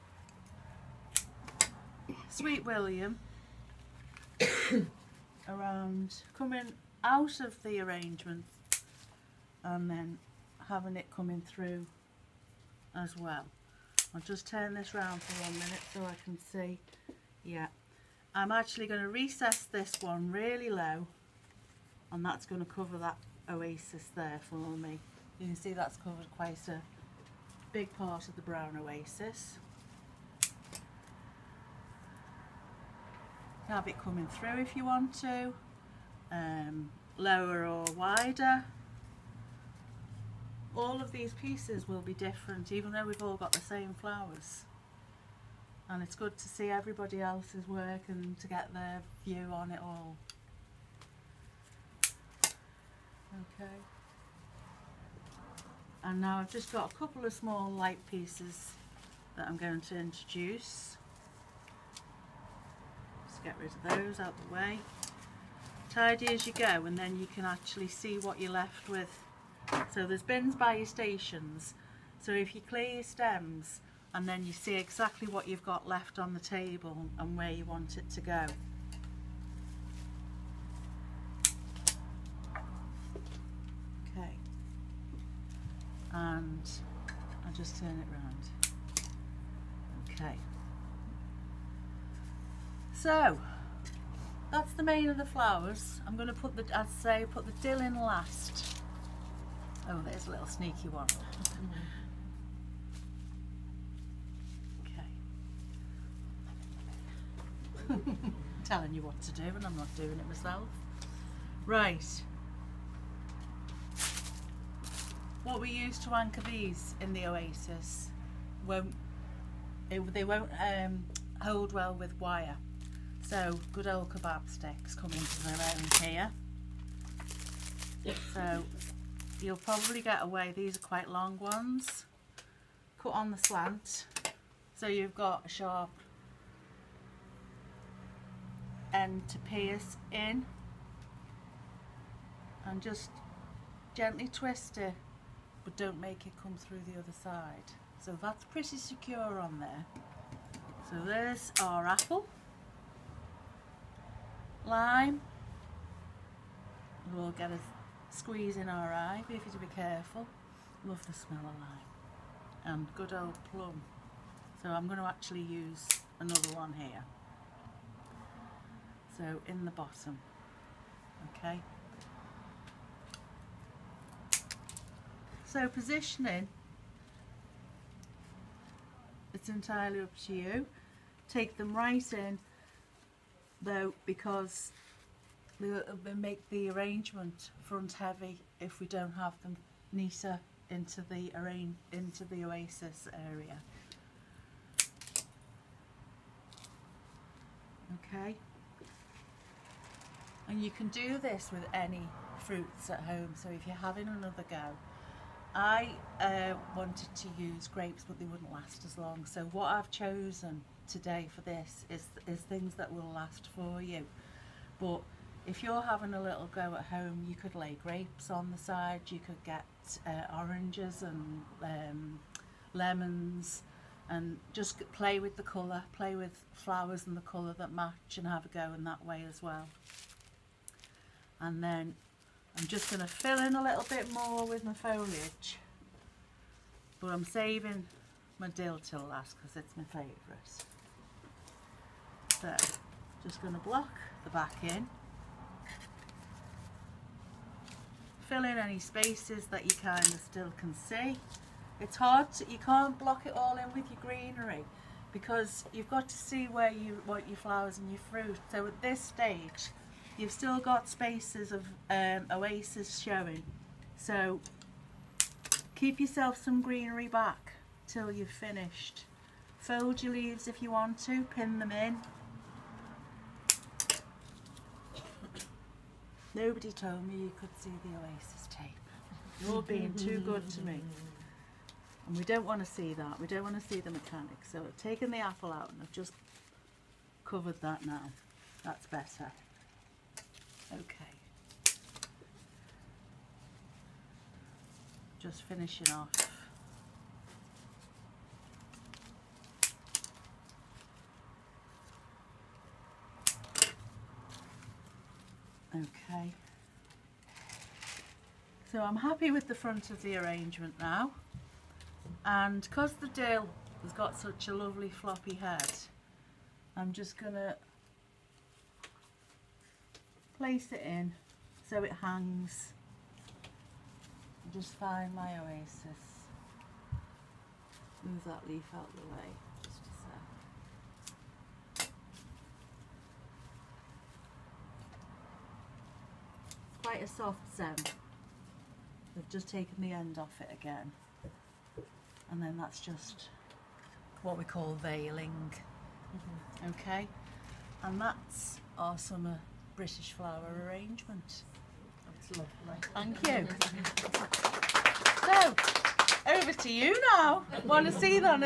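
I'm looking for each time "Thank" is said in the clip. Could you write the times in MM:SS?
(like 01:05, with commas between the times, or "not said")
05:52.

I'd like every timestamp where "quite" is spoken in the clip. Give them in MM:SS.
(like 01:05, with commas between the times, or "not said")
00:26, 02:10, 05:36.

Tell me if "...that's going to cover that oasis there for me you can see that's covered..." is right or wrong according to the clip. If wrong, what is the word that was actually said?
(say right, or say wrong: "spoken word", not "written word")
right.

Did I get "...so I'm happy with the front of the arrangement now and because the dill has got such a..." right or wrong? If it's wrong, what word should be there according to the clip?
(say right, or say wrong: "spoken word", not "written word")
right.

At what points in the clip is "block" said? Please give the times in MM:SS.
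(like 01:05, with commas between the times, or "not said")
04:03, 04:12.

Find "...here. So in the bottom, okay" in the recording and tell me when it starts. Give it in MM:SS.
02:46.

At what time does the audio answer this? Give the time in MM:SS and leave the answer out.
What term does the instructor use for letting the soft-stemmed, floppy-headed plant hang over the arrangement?
05:44.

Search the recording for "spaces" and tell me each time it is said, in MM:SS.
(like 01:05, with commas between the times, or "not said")
04:08, 04:20.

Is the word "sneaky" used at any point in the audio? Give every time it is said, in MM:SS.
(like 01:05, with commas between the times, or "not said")
01:40.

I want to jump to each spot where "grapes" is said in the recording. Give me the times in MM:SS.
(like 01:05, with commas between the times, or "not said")
03:27, 03:37.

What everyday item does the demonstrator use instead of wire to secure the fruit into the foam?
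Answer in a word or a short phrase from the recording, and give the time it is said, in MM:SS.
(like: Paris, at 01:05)
Kebab sticks, at 02:04.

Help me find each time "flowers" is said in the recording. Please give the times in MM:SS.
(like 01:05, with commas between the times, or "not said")
00:43, 01:35, 03:46, 04:17, 05:50.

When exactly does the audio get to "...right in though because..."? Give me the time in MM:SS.
03:01.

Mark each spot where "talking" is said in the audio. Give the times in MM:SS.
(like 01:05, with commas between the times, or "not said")
not said.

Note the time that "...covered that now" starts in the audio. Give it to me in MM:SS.
04:47.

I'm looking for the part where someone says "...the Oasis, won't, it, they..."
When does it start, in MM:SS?
01:57.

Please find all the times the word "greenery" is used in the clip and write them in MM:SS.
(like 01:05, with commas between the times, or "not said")
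04:14, 04:26.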